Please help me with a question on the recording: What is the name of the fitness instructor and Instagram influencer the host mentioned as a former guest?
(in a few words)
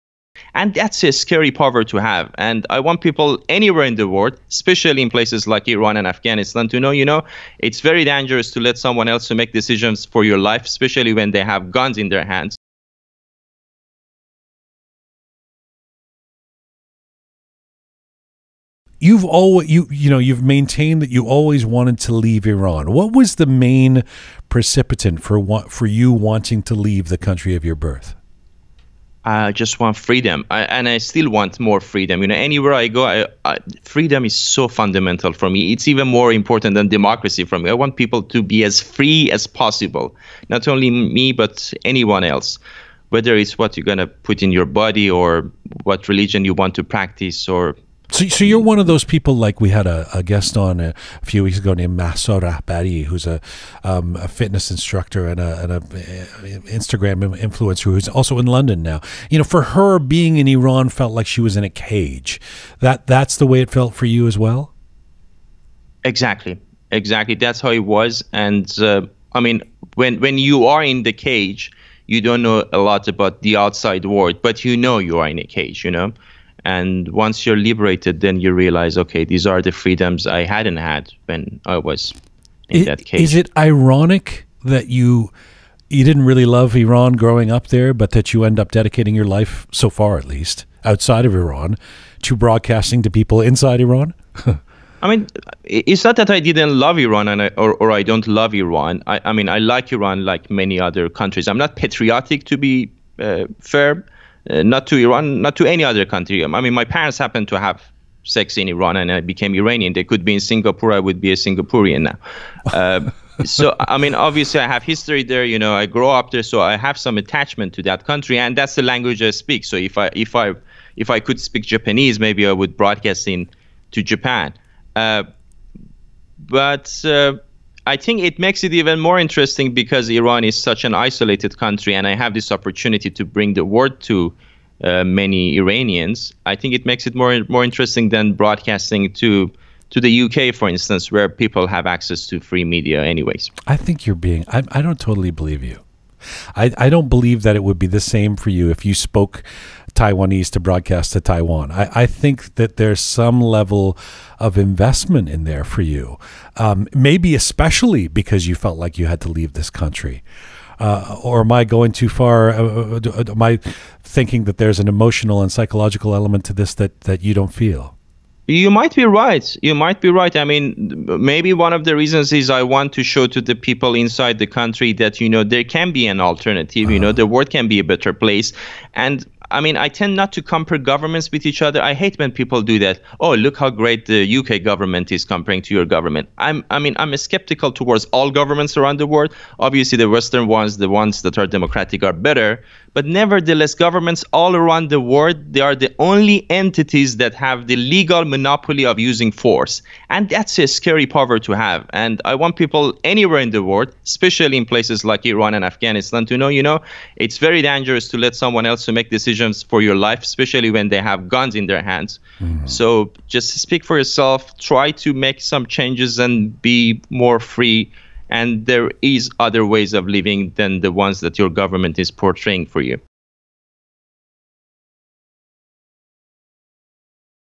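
Maso Badi.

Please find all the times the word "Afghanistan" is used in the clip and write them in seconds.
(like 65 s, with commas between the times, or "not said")
6 s, 205 s.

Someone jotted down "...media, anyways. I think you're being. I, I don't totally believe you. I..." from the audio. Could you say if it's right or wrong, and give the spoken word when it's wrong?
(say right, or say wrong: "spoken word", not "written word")
right.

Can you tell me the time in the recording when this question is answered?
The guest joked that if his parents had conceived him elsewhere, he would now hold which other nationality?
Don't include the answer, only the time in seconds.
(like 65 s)
111 s.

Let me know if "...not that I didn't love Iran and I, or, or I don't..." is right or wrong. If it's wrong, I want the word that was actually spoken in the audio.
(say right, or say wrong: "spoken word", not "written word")
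right.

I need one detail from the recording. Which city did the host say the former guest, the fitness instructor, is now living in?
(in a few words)
London.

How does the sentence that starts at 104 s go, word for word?
Uh, not to Iran, not to any other country.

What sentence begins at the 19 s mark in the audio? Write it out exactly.
You've always you you know you've maintained that you always wanted to leave Iran.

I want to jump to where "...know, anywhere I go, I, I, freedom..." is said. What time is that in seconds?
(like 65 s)
32 s.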